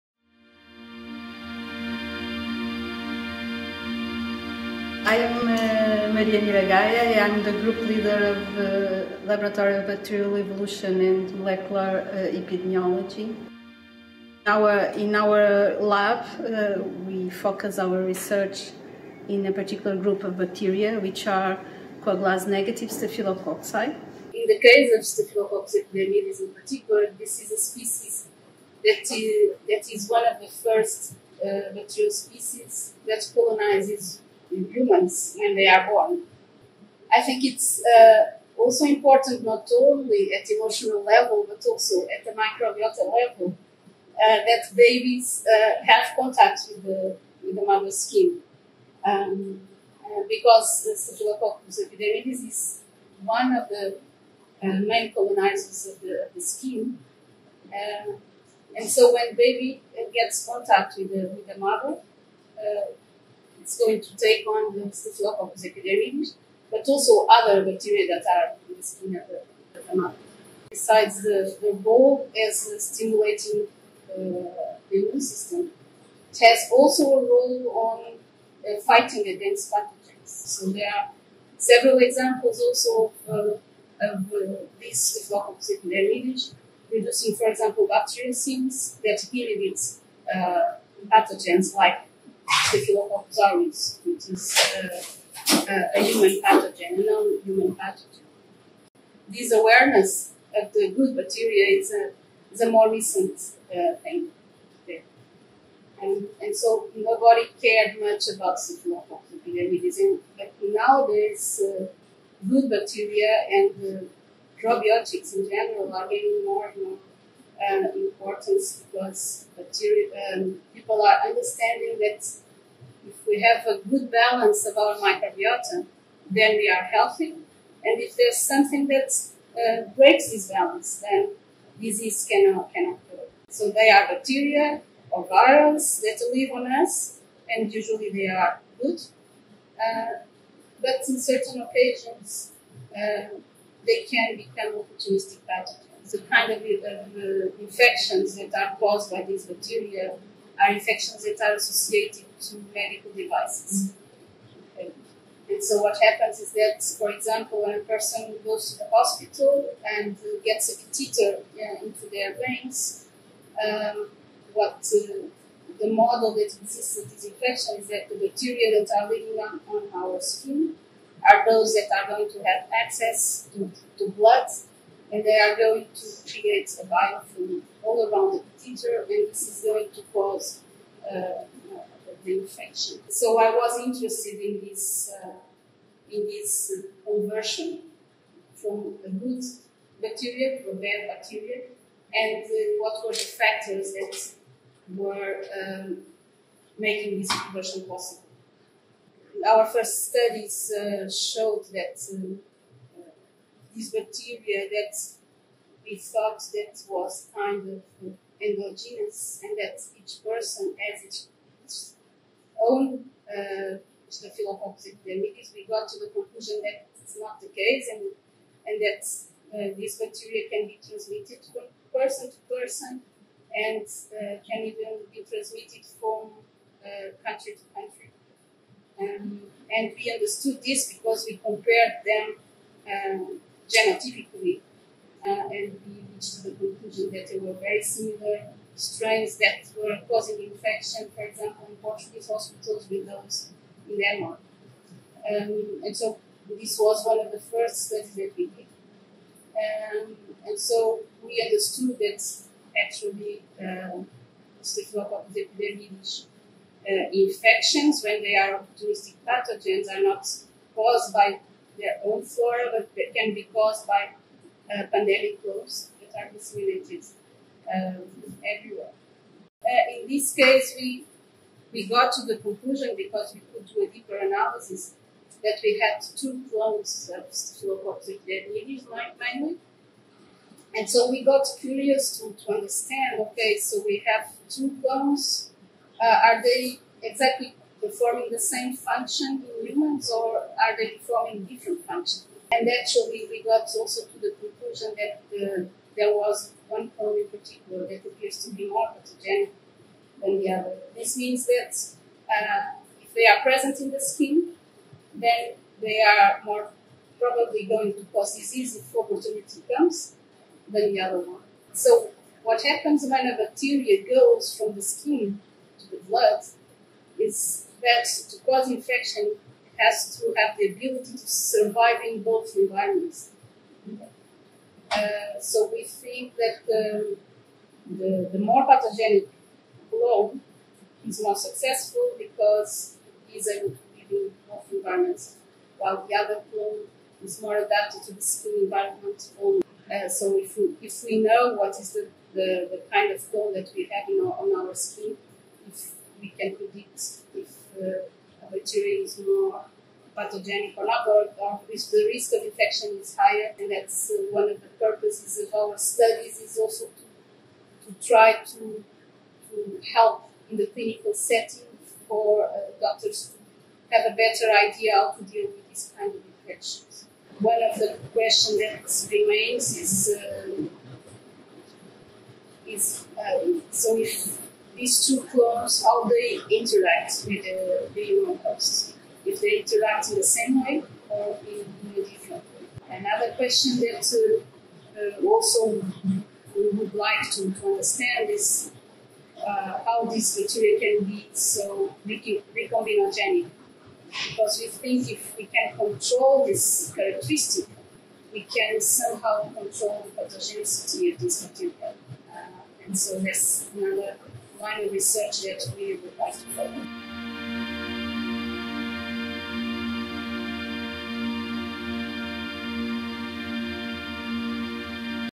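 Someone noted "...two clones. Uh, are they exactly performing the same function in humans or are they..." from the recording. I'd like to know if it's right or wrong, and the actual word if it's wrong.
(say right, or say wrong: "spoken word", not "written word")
right.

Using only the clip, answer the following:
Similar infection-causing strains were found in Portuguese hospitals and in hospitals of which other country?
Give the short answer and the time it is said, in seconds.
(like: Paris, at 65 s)
Denmark, at 243 s.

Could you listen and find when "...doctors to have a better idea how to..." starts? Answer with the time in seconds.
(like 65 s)
362 s.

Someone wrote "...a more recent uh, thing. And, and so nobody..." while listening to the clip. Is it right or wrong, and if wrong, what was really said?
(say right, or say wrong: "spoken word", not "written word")
right.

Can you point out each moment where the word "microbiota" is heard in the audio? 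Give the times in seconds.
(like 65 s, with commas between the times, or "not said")
42 s, 124 s.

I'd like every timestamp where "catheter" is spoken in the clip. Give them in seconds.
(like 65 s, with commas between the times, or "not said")
160 s, 178 s.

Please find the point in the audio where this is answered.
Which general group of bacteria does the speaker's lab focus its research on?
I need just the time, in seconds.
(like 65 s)
22 s.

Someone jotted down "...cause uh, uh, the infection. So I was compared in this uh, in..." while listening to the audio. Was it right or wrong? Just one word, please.
wrong.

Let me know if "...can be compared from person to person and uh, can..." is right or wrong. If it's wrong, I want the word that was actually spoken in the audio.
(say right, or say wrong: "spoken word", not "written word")
wrong: "transmitted", not "compared".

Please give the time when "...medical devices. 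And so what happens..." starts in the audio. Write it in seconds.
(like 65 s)
152 s.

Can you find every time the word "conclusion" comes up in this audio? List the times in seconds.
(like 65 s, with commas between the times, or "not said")
216 s, 236 s, 272 s, 294 s.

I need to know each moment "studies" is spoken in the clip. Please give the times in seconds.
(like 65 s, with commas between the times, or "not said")
200 s, 247 s, 355 s.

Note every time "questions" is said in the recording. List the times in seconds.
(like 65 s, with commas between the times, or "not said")
368 s, 383 s.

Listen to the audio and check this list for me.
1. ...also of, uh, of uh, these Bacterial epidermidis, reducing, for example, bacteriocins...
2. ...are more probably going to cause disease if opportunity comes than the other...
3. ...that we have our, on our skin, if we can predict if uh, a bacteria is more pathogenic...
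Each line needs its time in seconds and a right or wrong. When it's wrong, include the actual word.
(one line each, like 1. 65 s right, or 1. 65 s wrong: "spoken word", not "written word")
1. 82 s wrong: "Staphylococcus", not "Bacterial"
2. 306 s right
3. 343 s right.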